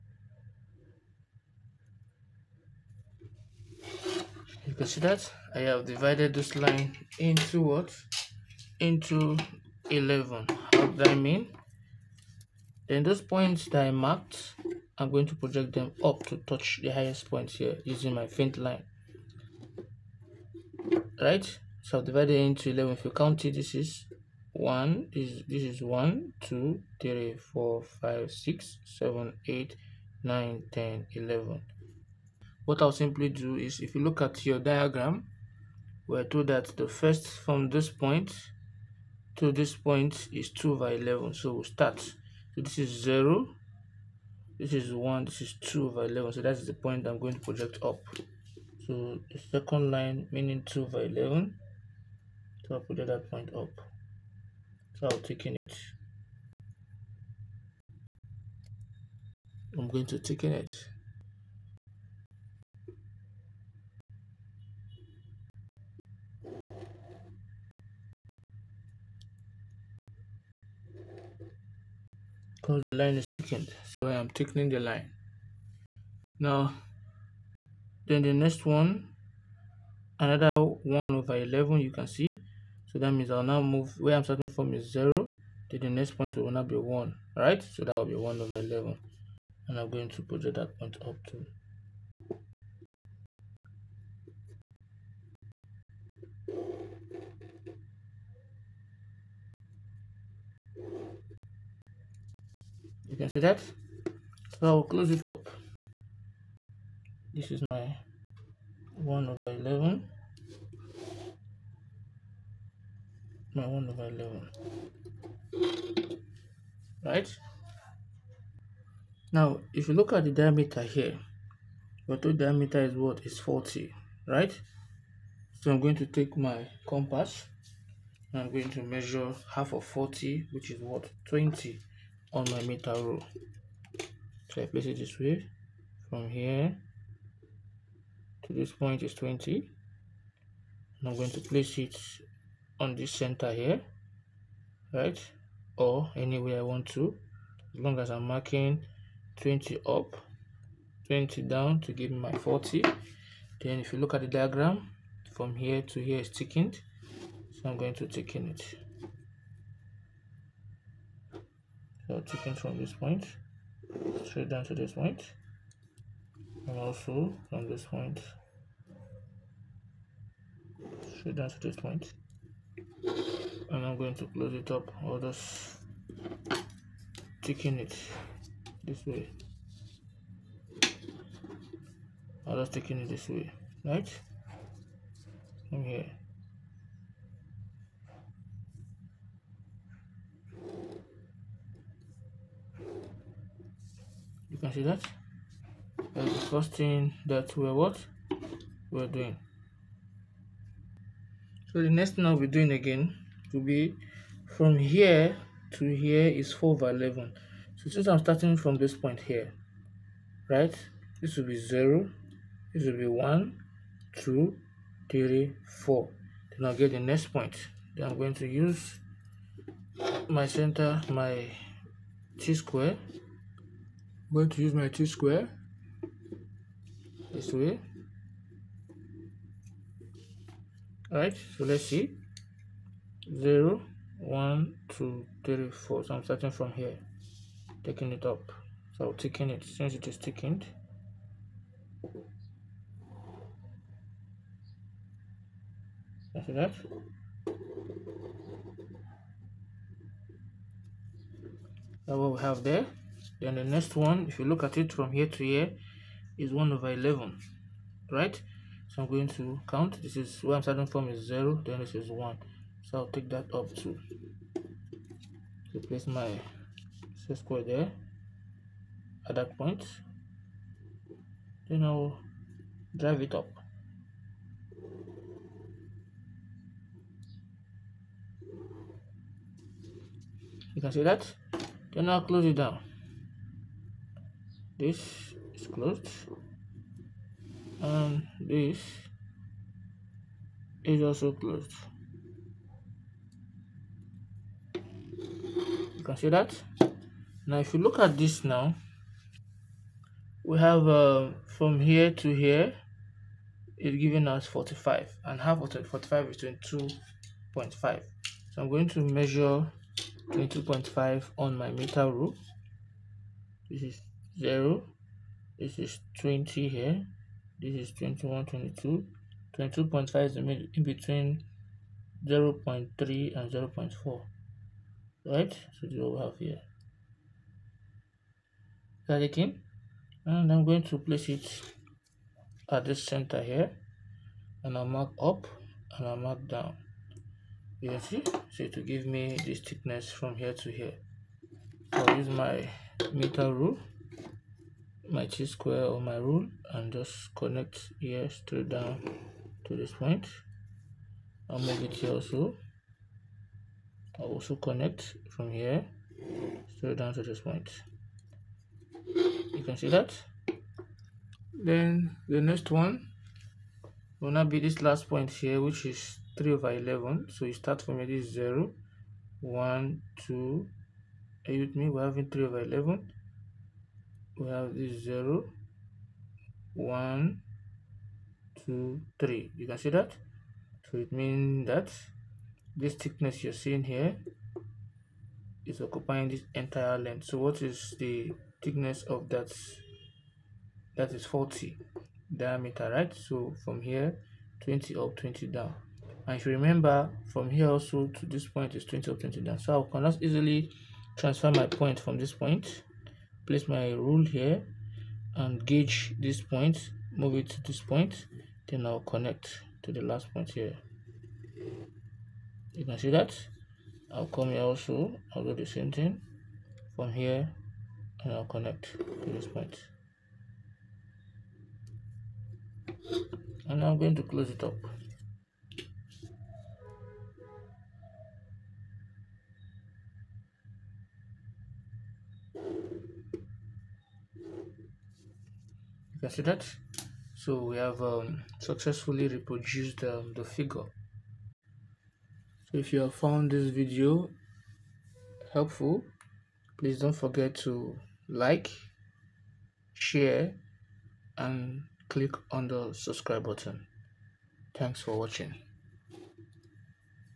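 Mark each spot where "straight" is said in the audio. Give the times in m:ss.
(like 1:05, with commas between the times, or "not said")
2:44, 2:51, 5:48, 5:56.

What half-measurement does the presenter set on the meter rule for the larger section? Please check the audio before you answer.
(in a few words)
22.5.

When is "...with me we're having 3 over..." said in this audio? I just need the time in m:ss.
6:11.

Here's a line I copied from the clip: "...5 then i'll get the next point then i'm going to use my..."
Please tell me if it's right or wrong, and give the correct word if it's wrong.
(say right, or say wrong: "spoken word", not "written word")
wrong: "4", not "5".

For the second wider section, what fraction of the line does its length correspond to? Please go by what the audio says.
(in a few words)
4/11.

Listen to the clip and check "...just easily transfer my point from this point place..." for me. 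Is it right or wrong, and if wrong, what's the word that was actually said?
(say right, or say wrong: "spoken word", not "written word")
right.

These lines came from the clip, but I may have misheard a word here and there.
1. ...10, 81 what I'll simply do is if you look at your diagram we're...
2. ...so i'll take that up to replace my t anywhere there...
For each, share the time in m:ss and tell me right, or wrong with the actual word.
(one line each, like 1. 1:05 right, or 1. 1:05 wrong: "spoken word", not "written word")
1. 0:30 wrong: "11", not "81"
2. 4:22 wrong: "square", not "anywhere".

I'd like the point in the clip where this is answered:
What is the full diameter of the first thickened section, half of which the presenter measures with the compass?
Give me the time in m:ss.
2:02.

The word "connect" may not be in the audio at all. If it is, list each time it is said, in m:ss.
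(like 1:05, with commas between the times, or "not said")
5:47, 5:54, 6:49, 6:58.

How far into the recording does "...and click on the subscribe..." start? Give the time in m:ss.
7:31.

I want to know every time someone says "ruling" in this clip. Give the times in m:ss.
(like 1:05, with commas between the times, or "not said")
not said.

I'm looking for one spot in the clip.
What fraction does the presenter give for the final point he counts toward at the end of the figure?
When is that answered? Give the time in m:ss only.
6:05.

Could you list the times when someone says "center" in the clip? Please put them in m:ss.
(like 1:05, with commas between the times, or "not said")
2:23, 3:40, 5:33.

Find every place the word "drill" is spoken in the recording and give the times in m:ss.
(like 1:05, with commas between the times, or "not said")
not said.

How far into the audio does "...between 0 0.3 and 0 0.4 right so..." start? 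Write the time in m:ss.
5:20.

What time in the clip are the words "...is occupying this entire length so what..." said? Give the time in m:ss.
6:25.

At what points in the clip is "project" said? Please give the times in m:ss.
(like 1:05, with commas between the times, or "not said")
0:15, 0:47, 0:52, 1:30.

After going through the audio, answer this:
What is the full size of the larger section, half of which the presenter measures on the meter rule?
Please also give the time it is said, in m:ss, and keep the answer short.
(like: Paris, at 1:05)
45, at 5:03.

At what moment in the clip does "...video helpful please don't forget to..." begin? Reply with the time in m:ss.
7:23.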